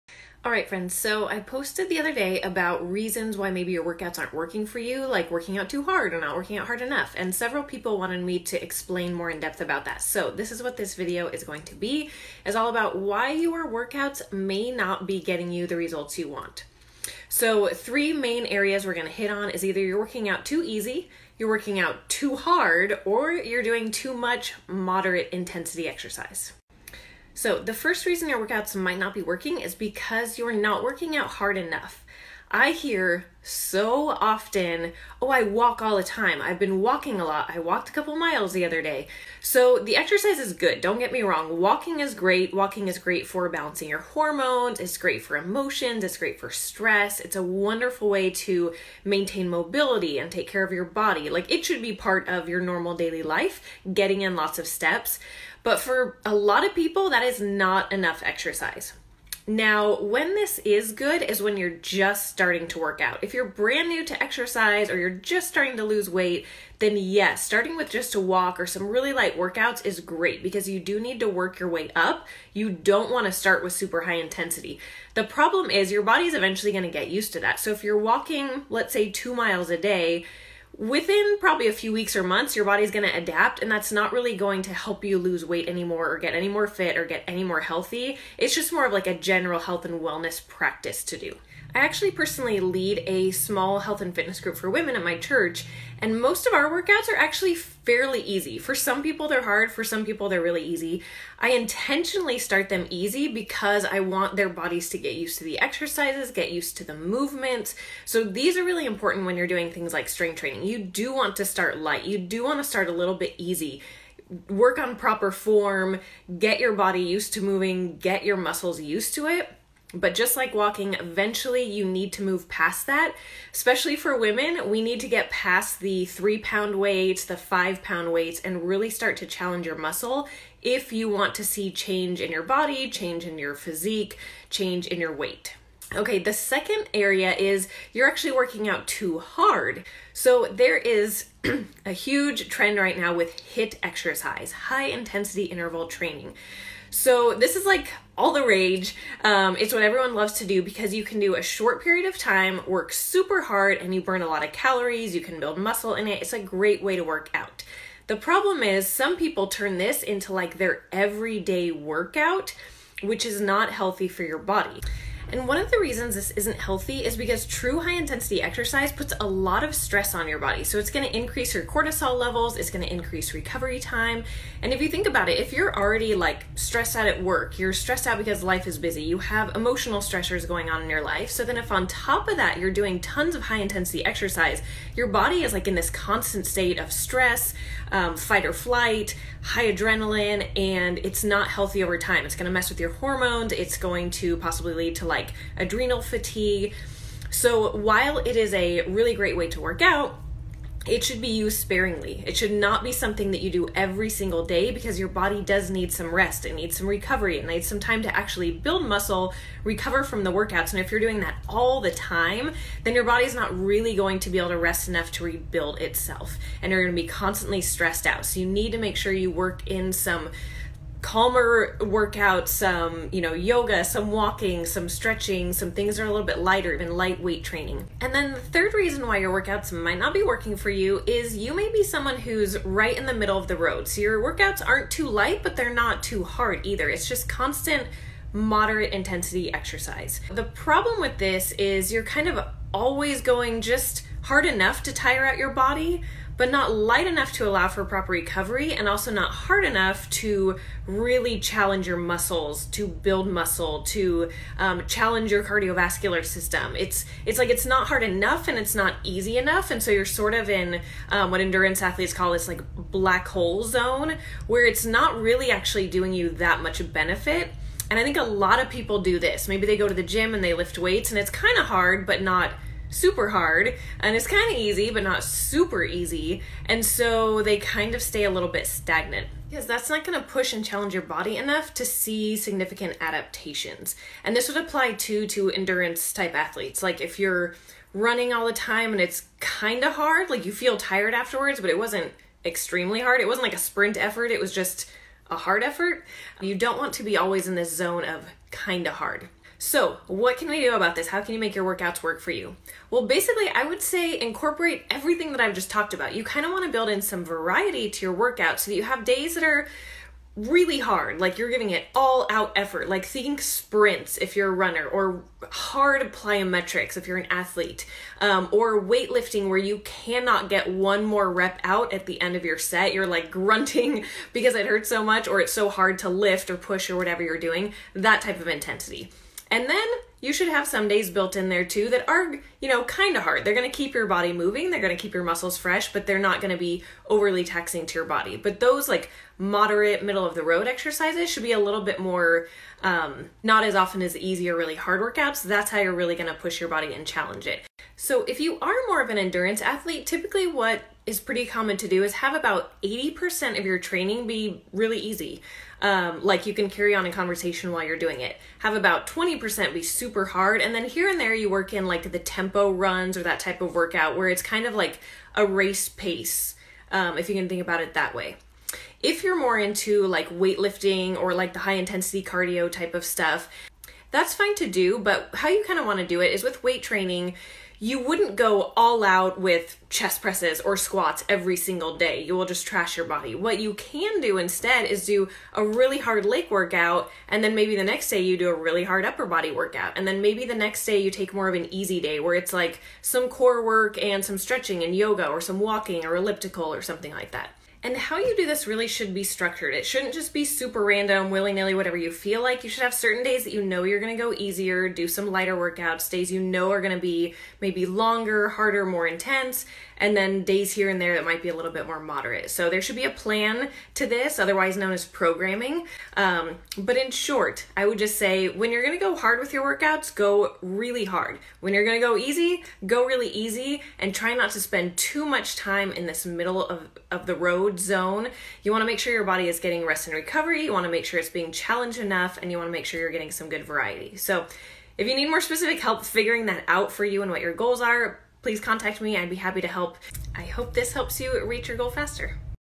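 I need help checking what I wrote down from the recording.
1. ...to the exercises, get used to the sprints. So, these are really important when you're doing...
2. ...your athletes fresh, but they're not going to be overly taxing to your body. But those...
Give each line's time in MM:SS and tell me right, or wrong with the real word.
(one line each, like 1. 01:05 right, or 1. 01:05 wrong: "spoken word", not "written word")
1. 01:45 wrong: "movements", not "sprints"
2. 05:35 wrong: "muscles", not "athletes".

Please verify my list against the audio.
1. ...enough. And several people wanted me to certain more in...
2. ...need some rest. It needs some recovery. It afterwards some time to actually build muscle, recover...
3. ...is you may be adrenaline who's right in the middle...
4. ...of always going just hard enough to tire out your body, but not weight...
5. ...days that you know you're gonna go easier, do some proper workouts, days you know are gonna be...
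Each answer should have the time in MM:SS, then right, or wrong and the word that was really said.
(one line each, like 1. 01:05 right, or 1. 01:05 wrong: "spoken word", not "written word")
1. 00:06 wrong: "explain", not "certain"
2. 03:25 wrong: "needs", not "afterwards"
3. 03:51 wrong: "someone", not "adrenaline"
4. 04:02 wrong: "light", not "weight"
5. 06:43 wrong: "lighter", not "proper".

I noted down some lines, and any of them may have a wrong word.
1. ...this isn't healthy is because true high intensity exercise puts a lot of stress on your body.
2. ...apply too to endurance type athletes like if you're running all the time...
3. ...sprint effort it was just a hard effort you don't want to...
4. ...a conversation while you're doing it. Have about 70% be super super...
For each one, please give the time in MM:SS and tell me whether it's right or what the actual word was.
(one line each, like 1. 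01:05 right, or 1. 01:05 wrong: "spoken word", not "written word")
1. 02:46 right
2. 04:44 right
3. 04:53 right
4. 05:57 wrong: "20", not "70".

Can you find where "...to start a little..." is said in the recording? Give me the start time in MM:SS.
01:52.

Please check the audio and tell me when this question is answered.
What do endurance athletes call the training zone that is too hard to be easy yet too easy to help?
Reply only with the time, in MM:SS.
04:22.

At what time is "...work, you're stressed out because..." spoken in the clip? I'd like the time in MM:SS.
02:57.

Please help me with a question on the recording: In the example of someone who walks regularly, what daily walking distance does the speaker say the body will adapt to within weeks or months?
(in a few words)
2 miles.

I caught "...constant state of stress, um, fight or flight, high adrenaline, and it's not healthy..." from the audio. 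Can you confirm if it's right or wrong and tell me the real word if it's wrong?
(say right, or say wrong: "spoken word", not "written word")
right.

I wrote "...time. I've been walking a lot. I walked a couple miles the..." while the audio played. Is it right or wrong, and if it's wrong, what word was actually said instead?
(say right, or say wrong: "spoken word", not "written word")
right.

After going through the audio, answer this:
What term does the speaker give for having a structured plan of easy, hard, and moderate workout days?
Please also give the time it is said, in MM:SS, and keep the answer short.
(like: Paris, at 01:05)
programming, at 06:55.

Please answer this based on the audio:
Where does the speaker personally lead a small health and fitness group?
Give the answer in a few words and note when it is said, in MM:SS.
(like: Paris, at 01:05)
at my church, at 01:34.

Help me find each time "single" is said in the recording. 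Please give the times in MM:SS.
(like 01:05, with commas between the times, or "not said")
03:24, 06:21.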